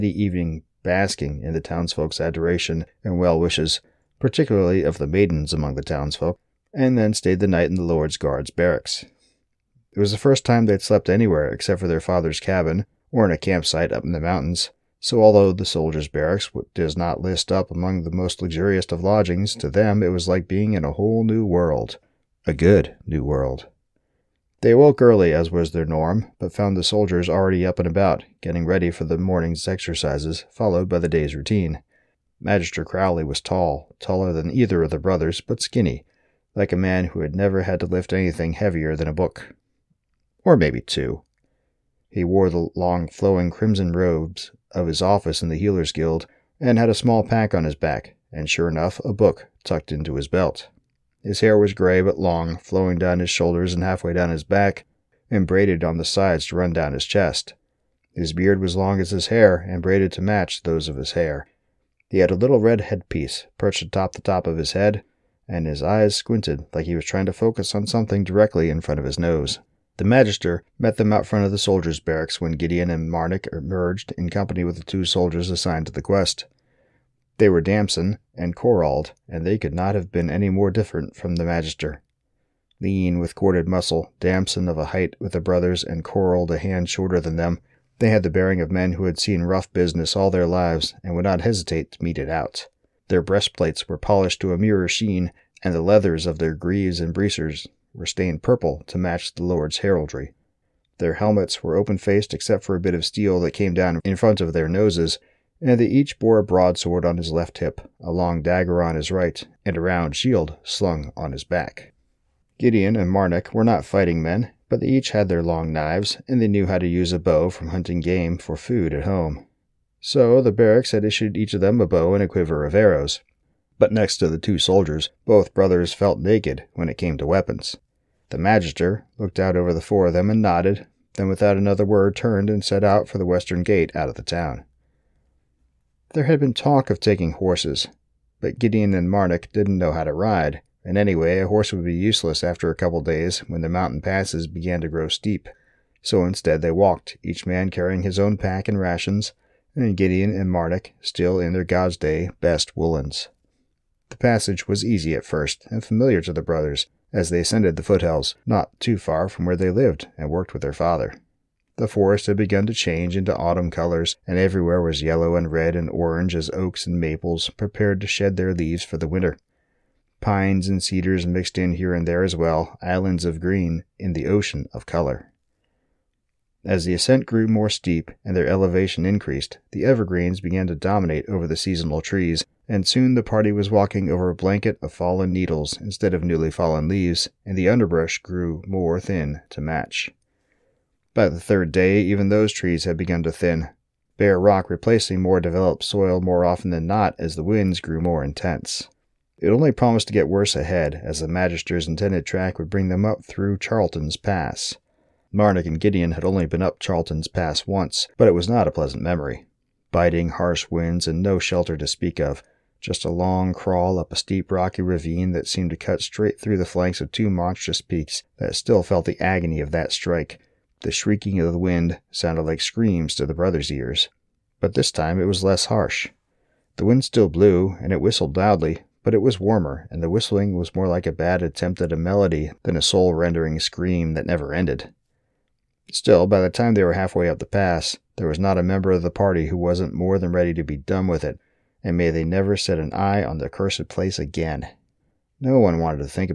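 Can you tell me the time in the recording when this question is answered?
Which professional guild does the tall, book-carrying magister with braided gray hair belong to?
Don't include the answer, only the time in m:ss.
0:45.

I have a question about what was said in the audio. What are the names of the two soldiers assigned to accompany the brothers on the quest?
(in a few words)
Damson and Corald.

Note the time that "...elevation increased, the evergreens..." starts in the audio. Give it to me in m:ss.
2:58.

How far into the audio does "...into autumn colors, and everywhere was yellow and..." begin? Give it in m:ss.
2:43.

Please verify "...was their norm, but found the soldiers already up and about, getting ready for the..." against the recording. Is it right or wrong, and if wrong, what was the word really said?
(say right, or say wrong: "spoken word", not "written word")
right.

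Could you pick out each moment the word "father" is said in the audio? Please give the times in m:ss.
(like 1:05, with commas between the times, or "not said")
0:11, 2:40.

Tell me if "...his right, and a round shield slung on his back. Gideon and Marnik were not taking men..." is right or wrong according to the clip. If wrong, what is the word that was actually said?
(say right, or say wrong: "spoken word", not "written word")
wrong: "fighting", not "taking".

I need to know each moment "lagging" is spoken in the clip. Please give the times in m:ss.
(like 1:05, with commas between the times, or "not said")
not said.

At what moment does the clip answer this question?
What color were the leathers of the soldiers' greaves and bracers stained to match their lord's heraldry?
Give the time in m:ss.
1:38.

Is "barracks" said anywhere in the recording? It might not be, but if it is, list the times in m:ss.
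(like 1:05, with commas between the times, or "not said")
0:08, 0:16, 1:11, 2:00.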